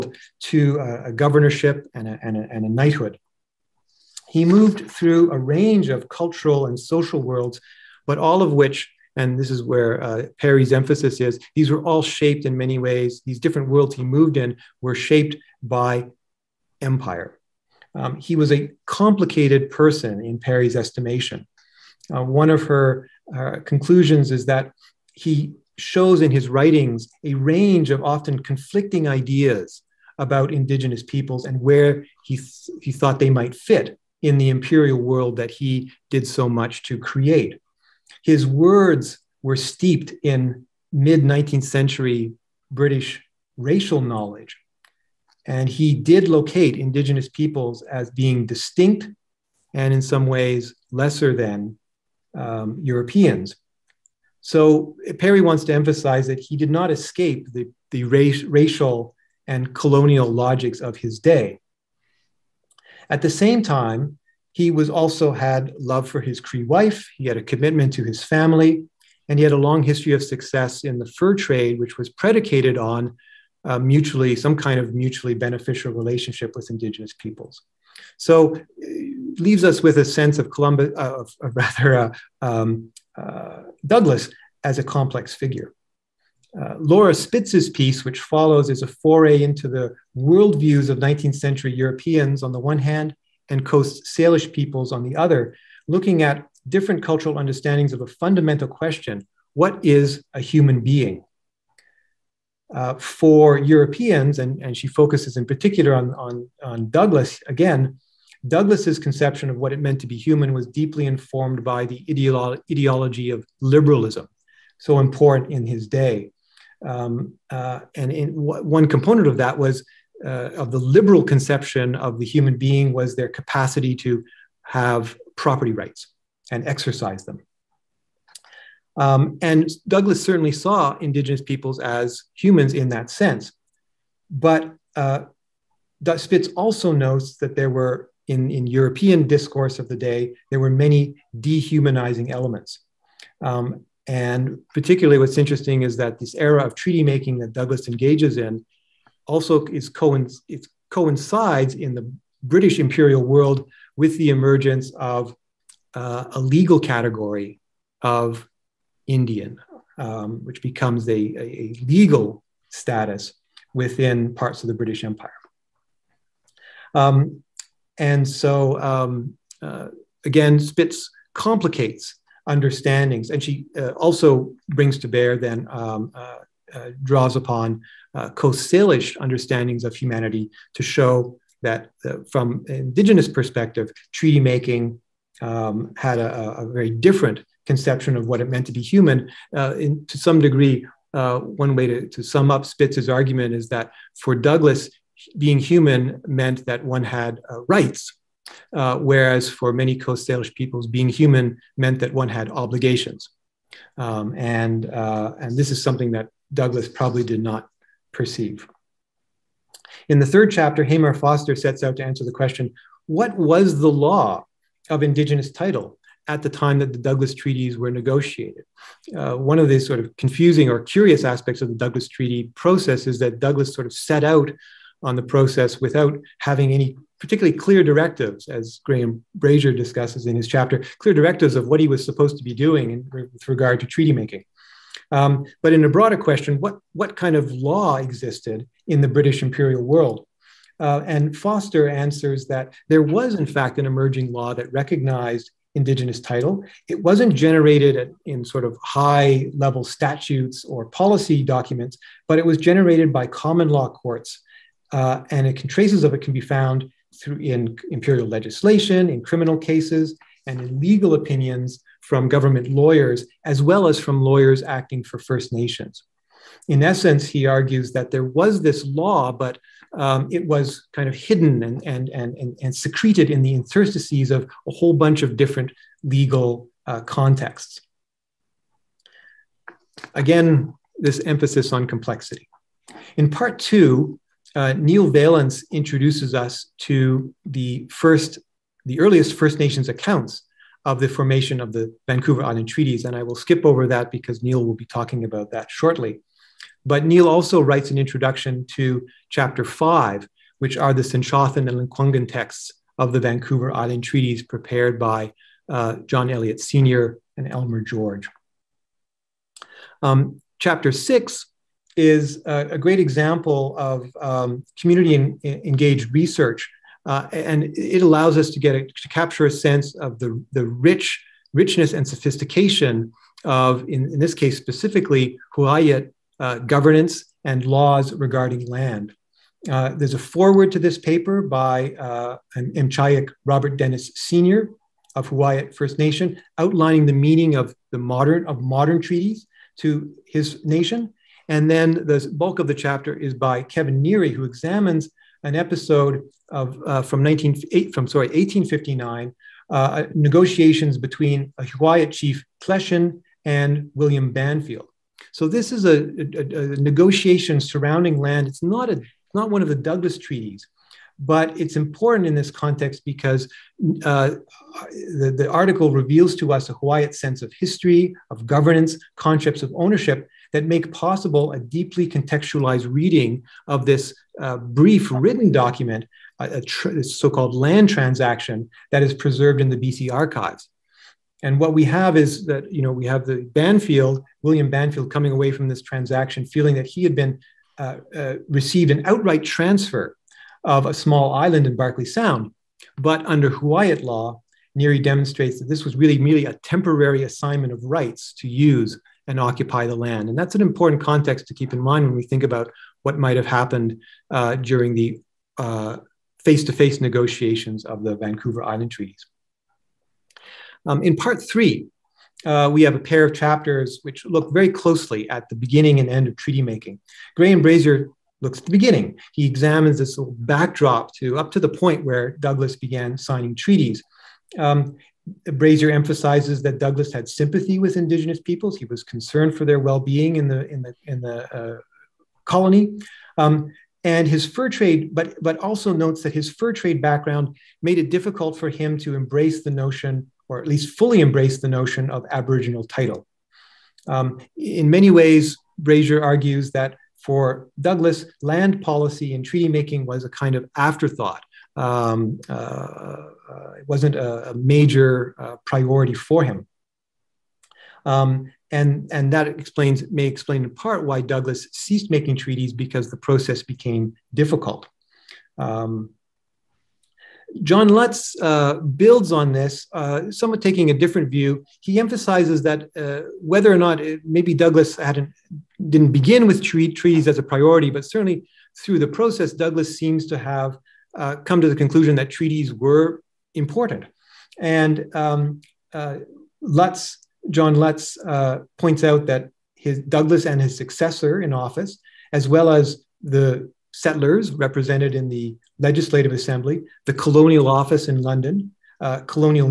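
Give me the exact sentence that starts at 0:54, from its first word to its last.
So Perry wants to emphasize that he did not escape the, the race, racial and colonial logics of his day.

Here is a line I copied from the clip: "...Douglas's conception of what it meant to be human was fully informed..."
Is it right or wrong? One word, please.
wrong.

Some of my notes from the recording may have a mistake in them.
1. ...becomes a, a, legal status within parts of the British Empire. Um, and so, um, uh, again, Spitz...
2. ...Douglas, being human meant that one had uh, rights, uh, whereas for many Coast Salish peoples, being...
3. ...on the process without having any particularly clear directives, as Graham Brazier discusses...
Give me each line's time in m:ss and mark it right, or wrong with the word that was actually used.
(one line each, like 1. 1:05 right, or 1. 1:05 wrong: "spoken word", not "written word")
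1. 2:40 right
2. 3:14 right
3. 3:45 right.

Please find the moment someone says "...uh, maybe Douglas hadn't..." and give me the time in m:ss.
7:54.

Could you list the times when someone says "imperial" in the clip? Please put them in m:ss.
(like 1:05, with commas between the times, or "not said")
0:34, 2:32, 3:59, 4:17.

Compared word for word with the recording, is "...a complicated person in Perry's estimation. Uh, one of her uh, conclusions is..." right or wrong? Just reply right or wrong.
right.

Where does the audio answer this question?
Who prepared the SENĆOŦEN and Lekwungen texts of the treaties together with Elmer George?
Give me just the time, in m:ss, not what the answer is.
5:06.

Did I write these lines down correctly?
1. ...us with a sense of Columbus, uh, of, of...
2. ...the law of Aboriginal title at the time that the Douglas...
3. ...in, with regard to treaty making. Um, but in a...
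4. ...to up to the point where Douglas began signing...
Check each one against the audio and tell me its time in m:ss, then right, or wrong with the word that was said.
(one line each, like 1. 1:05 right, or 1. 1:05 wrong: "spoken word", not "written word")
1. 1:19 right
2. 3:33 wrong: "Indigenous", not "Aboriginal"
3. 3:52 right
4. 7:01 right.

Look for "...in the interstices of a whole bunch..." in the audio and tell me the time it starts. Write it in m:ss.
4:33.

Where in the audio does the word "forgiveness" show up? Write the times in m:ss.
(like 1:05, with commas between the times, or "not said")
not said.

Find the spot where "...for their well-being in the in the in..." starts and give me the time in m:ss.
7:09.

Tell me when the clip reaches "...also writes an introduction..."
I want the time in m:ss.
4:57.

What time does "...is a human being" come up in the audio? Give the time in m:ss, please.
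1:39.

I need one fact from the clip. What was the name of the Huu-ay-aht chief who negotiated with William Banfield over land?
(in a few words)
Kleshin.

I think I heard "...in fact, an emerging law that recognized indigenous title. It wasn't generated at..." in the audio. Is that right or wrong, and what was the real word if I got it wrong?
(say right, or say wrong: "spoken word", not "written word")
right.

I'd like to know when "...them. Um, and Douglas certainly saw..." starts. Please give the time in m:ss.
2:07.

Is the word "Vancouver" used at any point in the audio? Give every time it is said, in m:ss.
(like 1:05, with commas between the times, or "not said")
4:52, 5:03, 6:48.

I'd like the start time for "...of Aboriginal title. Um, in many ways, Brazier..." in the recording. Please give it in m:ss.
7:22.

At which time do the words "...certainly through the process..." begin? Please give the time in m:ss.
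7:58.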